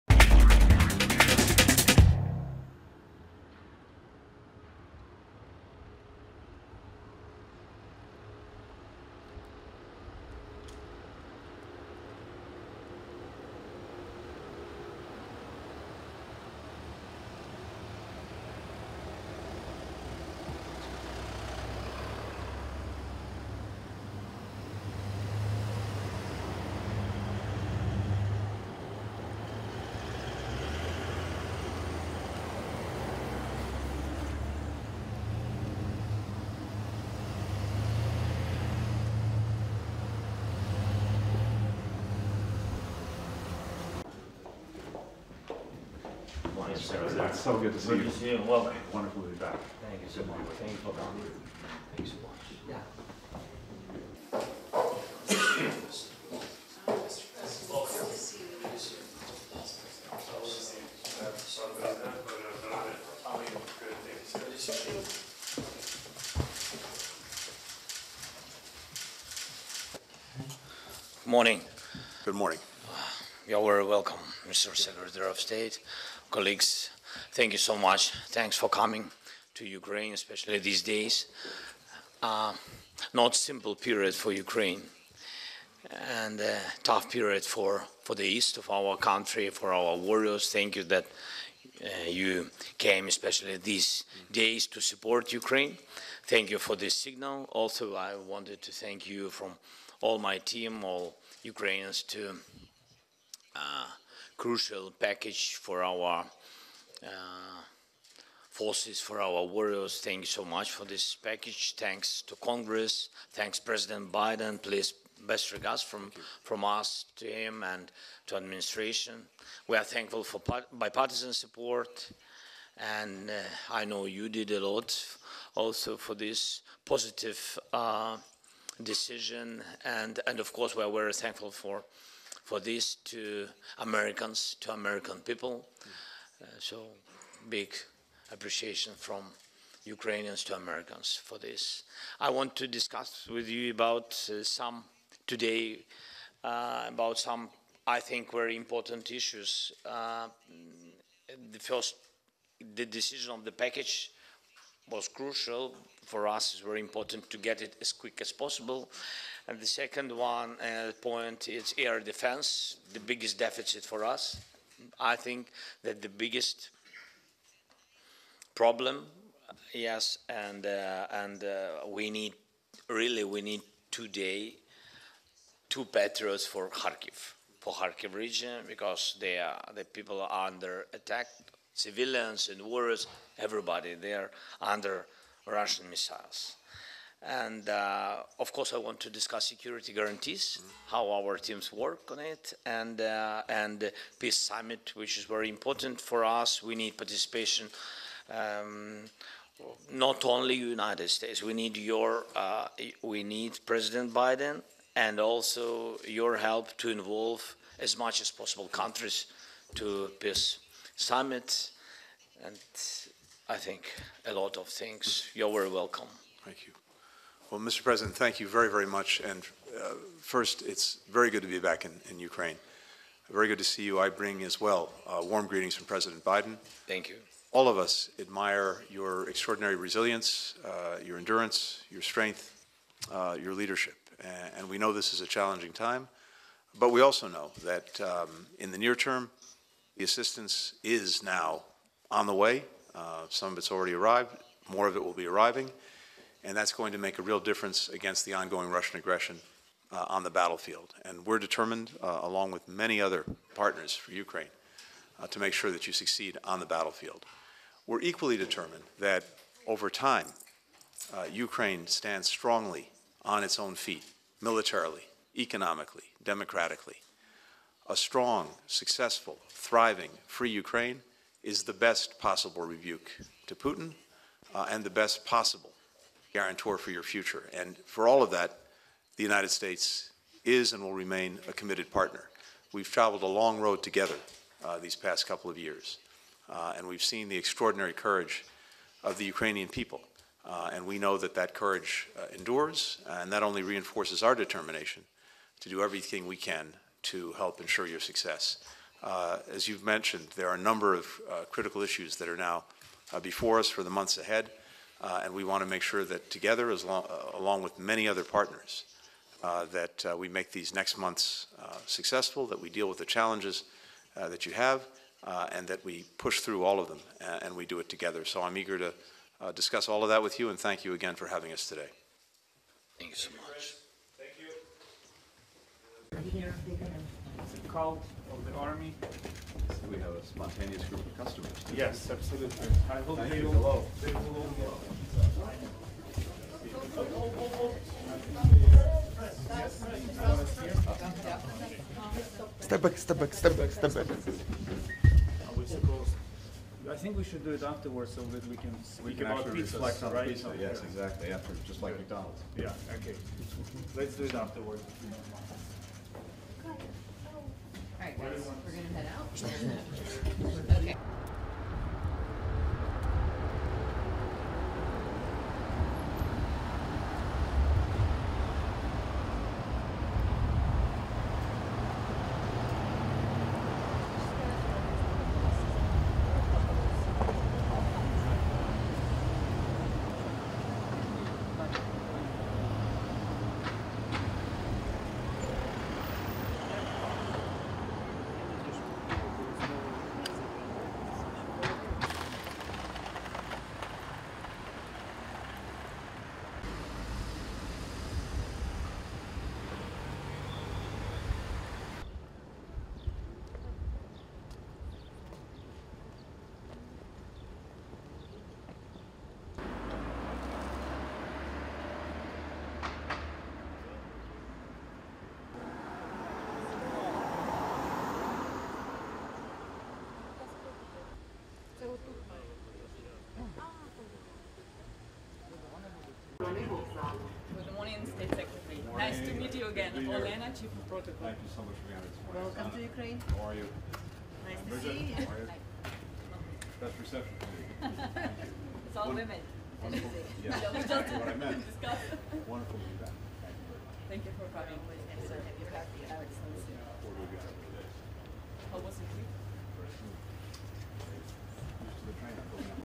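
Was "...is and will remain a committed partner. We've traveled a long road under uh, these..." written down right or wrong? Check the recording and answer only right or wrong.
wrong.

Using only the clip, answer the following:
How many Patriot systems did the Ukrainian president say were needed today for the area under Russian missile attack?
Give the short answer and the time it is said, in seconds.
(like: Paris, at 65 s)
2, at 175 s.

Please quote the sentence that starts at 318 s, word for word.
So I'm eager to discuss all of that with you, and thank you again for having us today.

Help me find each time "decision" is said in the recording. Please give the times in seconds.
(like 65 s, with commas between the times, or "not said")
128 s, 152 s.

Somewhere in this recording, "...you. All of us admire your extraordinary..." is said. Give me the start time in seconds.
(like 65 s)
227 s.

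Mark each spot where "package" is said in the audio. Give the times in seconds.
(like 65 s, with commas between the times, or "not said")
104 s, 111 s, 153 s.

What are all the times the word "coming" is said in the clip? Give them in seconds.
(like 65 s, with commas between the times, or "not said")
50 s, 78 s, 444 s.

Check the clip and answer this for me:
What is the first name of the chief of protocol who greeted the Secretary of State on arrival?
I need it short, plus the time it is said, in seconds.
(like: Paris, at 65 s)
Olena, at 429 s.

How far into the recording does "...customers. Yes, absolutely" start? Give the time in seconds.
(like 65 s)
331 s.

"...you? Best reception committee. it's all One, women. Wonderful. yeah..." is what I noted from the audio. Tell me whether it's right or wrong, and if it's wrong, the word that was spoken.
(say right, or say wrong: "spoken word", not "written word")
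right.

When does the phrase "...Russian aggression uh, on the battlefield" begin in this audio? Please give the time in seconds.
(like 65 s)
248 s.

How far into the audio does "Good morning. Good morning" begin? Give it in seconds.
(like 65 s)
71 s.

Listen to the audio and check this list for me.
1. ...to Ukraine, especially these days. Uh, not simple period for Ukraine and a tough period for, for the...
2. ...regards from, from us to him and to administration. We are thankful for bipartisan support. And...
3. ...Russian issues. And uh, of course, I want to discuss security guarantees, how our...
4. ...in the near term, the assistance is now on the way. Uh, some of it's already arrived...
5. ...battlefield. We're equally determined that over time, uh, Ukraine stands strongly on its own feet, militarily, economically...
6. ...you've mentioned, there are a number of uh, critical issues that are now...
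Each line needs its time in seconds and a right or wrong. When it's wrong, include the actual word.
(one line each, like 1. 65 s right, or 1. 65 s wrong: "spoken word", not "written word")
1. 79 s right
2. 115 s right
3. 185 s wrong: "missiles", not "issues"
4. 238 s right
5. 256 s right
6. 299 s right.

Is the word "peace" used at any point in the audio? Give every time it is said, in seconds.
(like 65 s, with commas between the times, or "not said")
194 s, 210 s.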